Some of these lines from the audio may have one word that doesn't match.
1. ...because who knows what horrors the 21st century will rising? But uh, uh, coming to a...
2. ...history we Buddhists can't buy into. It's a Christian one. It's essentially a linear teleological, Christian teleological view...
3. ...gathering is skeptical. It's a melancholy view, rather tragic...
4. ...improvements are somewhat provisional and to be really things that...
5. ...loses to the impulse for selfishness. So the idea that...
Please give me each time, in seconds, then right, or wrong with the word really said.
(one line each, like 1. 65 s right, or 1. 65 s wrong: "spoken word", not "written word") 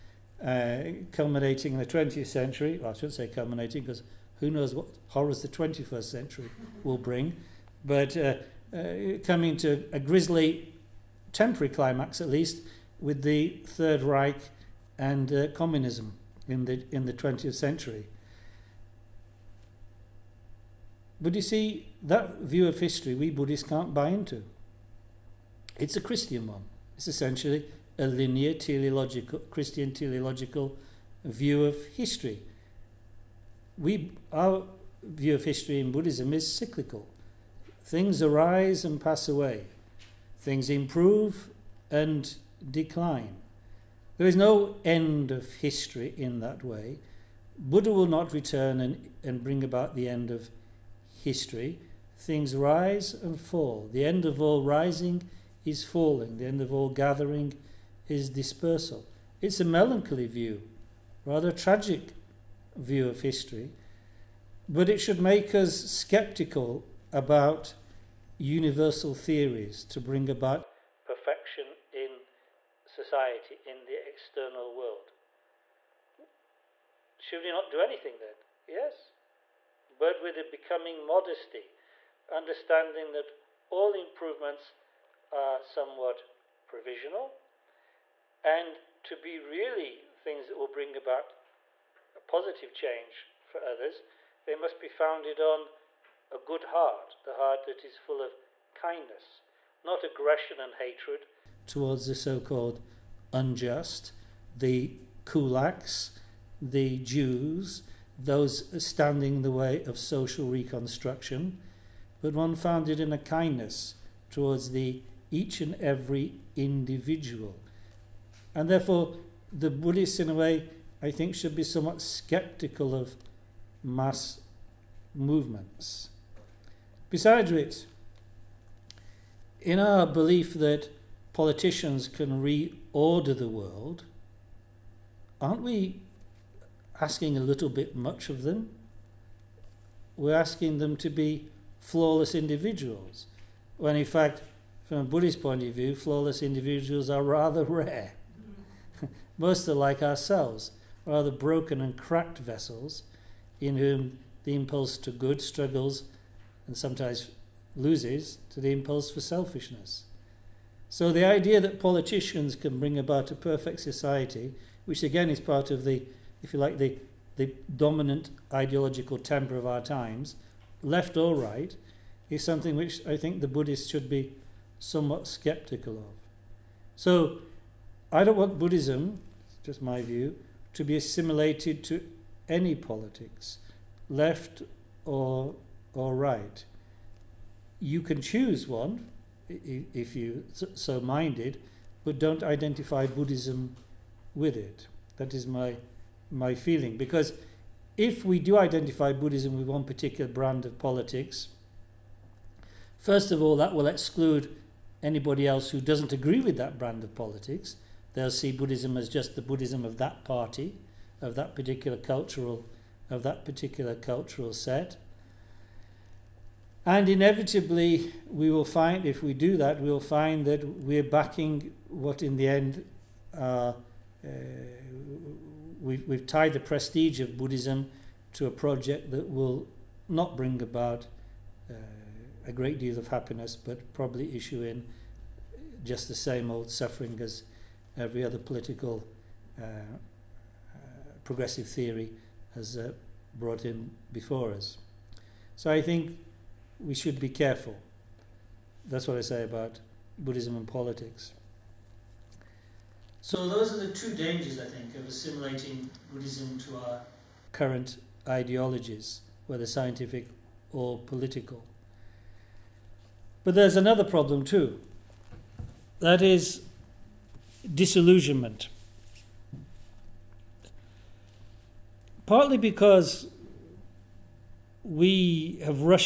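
1. 3 s wrong: "bring", not "rising"
2. 22 s right
3. 56 s wrong: "dispersal", not "skeptical"
4. 83 s right
5. 157 s right.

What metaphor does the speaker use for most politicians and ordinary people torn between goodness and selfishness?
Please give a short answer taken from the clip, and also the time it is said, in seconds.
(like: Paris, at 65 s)
broken and cracked vessels, at 151 s.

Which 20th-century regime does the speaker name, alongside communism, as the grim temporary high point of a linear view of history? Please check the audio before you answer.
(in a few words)
Third Reich.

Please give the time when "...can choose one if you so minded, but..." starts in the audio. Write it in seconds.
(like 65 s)
188 s.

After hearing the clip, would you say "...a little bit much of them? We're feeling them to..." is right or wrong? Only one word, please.
wrong.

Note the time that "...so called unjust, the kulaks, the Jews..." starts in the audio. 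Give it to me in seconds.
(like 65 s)
102 s.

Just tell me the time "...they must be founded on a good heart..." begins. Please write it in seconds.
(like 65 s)
94 s.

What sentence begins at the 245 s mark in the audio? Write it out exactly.
So I think we should be careful.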